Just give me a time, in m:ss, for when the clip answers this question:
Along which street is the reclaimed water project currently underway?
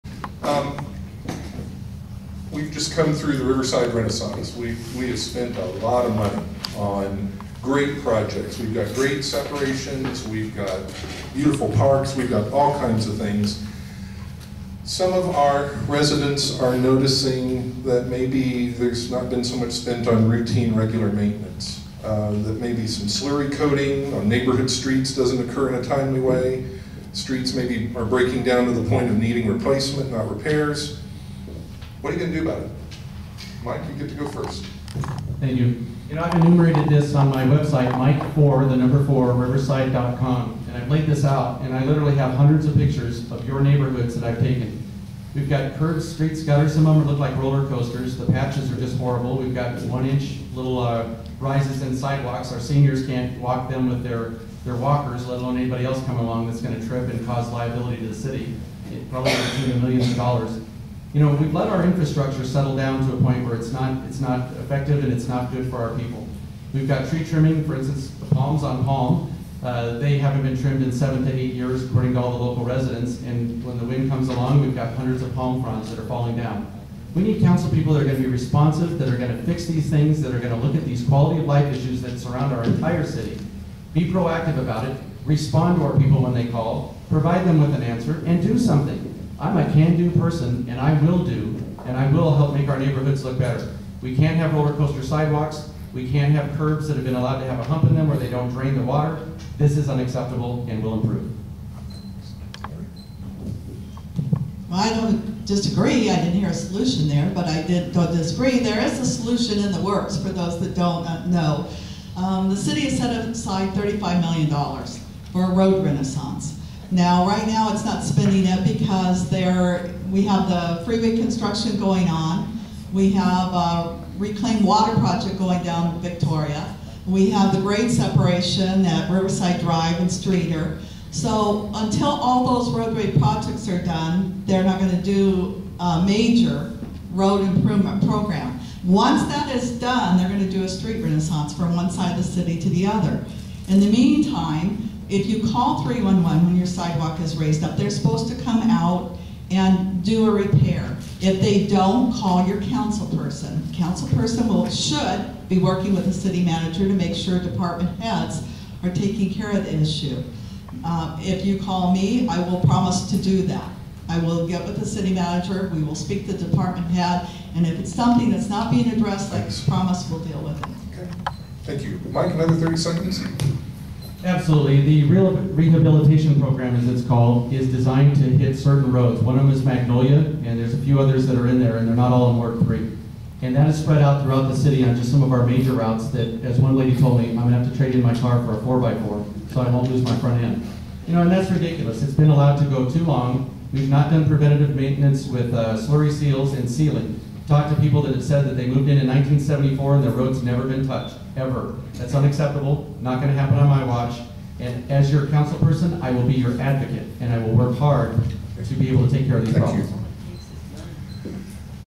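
2:06.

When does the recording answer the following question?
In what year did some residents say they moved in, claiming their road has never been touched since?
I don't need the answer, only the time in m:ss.
3:19.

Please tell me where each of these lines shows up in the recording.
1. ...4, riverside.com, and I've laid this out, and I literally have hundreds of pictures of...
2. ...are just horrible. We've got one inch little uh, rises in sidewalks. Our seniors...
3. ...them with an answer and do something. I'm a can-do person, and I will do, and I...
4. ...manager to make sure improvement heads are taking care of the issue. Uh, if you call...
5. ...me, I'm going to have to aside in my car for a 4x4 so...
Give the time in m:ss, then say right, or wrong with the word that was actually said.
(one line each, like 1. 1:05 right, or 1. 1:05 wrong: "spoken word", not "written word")
1. 0:39 right
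2. 0:48 right
3. 1:27 right
4. 2:36 wrong: "department", not "improvement"
5. 3:07 wrong: "trade", not "aside".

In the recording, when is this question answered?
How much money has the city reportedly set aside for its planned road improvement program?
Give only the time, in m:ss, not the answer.
1:53.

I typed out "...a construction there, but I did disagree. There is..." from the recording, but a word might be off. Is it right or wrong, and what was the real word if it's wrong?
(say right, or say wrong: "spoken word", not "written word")
wrong: "solution", not "construction".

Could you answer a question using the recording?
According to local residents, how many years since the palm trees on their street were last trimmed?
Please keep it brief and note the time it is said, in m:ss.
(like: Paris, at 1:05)
7 to 8 years, at 1:10.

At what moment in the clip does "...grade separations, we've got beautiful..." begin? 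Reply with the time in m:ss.
0:08.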